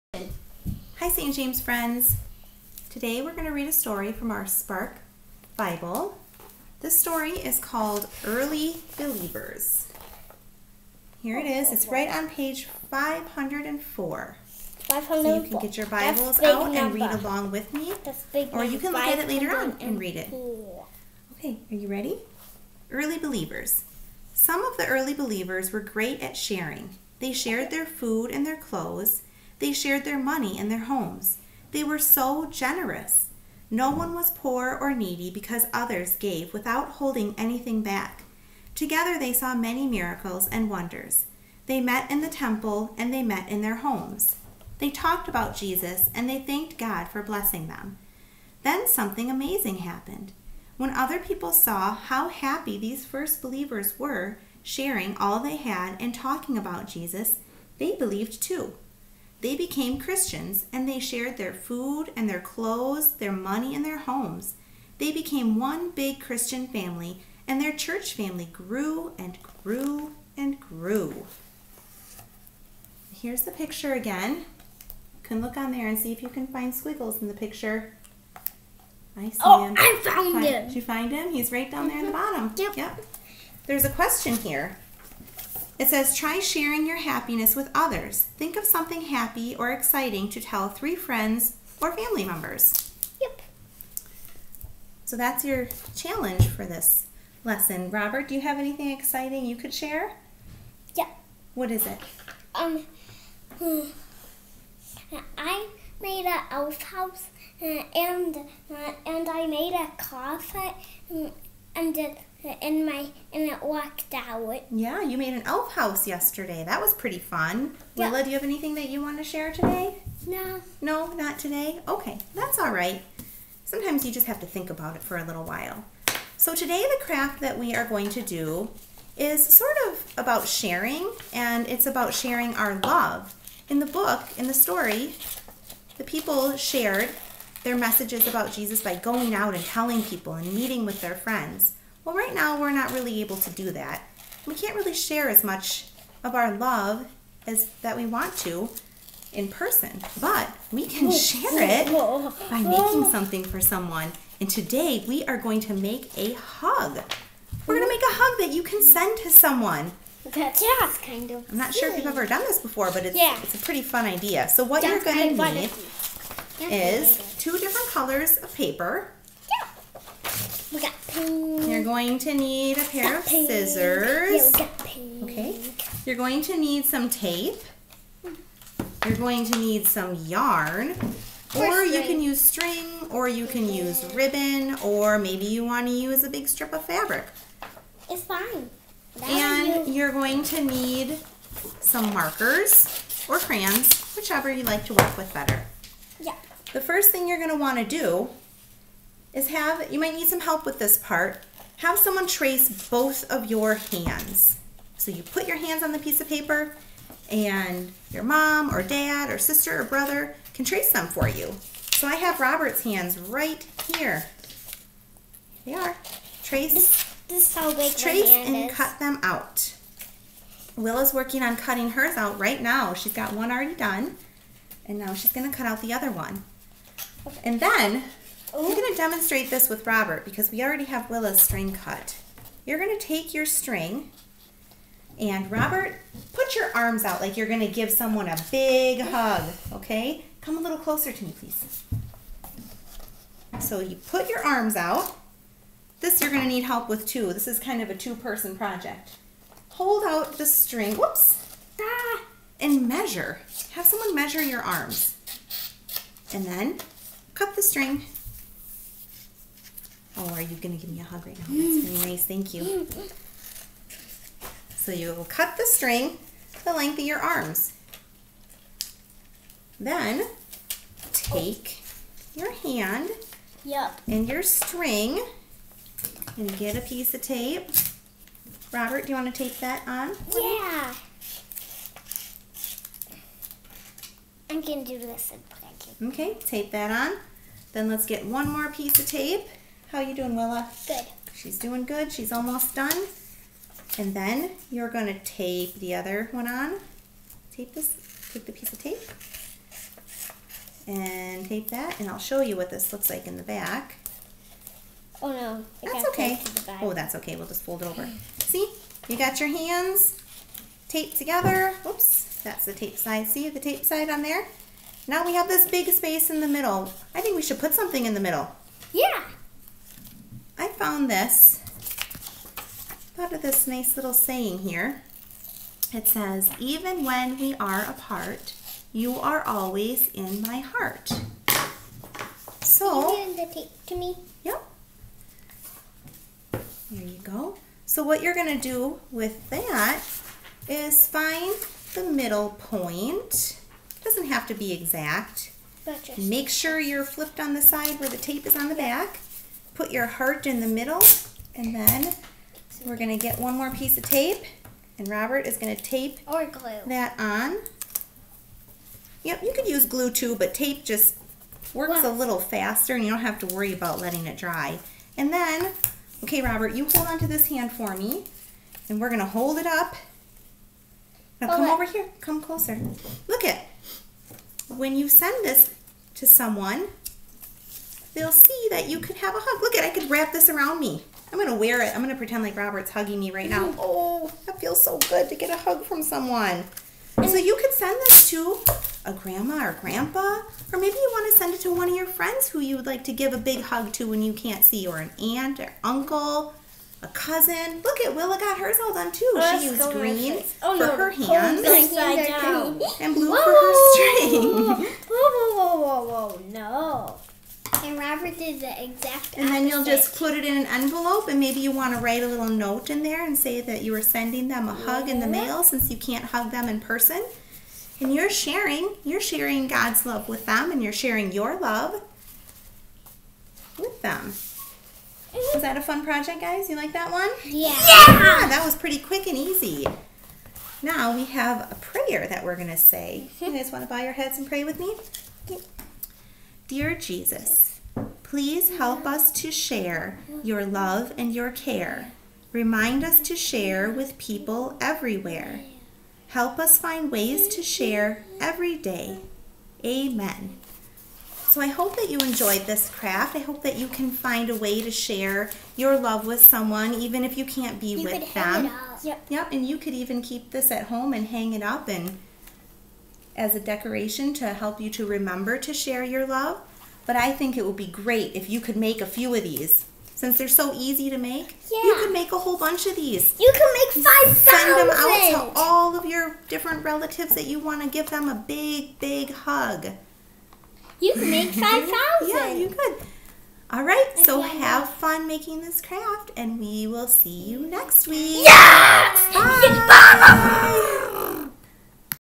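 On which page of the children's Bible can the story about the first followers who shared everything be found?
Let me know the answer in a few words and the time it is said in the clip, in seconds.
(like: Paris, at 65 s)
504, at 12 s.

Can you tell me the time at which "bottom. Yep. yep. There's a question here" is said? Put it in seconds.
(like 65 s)
82 s.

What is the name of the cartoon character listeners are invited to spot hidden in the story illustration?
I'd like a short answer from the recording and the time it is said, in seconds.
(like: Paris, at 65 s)
Squiggles, at 76 s.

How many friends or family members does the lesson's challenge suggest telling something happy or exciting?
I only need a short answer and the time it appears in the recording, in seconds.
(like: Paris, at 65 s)
3, at 90 s.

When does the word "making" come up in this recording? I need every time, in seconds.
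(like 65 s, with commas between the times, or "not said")
152 s, 485 s.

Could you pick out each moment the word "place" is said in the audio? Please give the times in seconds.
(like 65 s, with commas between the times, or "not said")
285 s.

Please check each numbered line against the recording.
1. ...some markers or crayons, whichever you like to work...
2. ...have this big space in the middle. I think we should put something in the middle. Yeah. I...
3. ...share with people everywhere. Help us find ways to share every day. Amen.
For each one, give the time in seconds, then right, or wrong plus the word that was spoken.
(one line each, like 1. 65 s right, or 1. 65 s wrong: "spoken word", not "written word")
1. 191 s right
2. 315 s right
3. 443 s right.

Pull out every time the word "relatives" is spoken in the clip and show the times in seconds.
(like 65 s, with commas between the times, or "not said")
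476 s.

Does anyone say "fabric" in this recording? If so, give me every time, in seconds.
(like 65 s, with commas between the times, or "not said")
186 s.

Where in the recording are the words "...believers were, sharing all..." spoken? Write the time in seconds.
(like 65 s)
53 s.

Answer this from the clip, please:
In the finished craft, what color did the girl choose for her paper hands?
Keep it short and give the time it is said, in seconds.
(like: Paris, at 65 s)
Green, at 399 s.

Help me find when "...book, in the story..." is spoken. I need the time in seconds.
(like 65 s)
133 s.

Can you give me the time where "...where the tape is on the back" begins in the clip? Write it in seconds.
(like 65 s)
347 s.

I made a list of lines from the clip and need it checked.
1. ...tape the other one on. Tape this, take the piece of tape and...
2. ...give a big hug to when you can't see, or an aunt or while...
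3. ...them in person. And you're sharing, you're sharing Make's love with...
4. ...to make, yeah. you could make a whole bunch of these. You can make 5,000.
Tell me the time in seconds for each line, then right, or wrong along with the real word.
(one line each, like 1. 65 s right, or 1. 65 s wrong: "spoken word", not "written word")
1. 295 s right
2. 393 s wrong: "uncle", not "while"
3. 416 s wrong: "God", not "Make"
4. 471 s right.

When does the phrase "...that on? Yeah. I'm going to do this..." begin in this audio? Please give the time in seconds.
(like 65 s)
279 s.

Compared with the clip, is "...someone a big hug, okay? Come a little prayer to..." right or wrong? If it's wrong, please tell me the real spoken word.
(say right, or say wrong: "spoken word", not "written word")
wrong: "closer", not "prayer".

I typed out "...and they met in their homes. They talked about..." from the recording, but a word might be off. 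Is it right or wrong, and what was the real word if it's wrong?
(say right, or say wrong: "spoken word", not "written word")
right.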